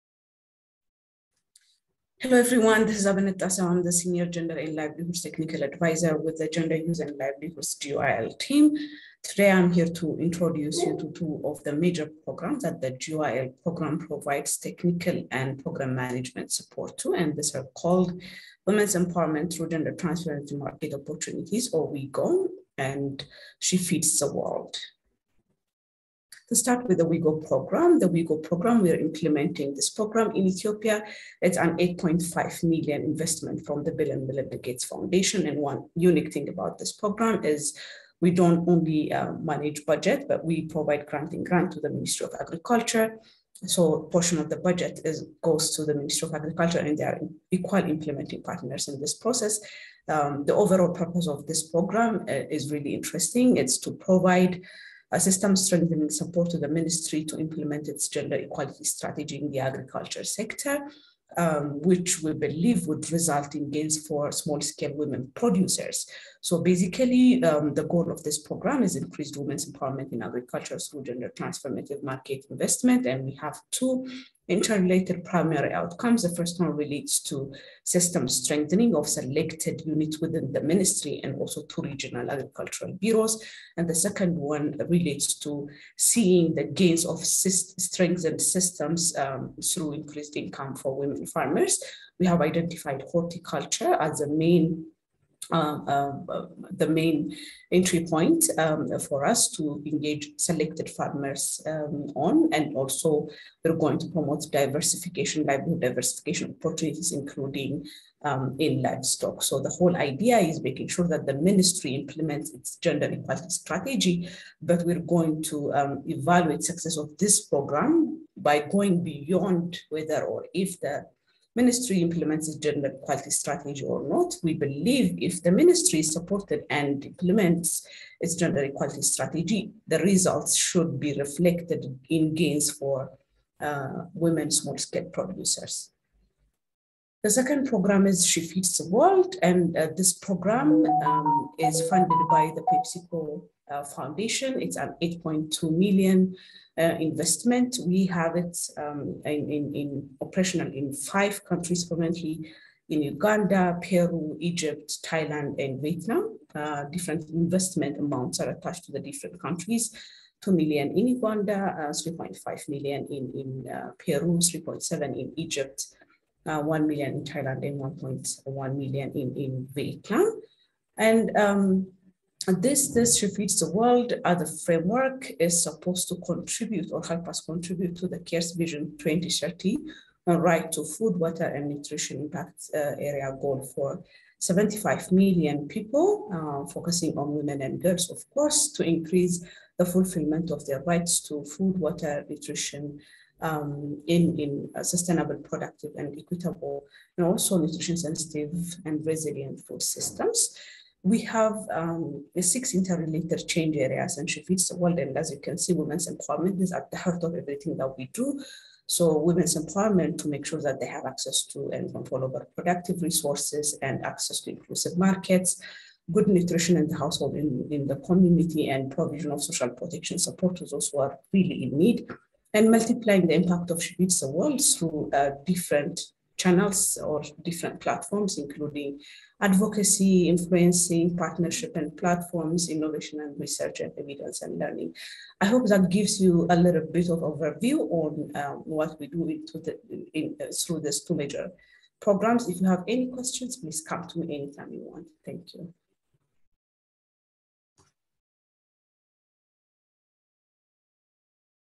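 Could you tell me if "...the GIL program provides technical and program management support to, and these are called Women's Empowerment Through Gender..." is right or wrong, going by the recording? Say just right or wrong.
right.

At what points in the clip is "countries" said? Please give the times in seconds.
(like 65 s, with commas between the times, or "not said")
151 s, 159 s.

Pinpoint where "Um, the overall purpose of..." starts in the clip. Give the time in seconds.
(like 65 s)
50 s.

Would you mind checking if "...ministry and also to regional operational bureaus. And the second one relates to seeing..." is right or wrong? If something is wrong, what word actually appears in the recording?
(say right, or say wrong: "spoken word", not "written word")
wrong: "agricultural", not "operational".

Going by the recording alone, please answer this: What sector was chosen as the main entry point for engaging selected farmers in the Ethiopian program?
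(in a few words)
Horticulture.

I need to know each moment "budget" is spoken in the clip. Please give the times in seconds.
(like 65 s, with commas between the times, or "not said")
39 s, 44 s.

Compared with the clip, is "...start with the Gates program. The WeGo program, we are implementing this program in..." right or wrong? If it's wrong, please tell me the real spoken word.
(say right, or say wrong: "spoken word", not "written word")
wrong: "WeGo", not "Gates".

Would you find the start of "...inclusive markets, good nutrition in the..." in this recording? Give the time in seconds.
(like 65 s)
214 s.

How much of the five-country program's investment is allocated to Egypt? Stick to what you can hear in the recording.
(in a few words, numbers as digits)
3.7 million.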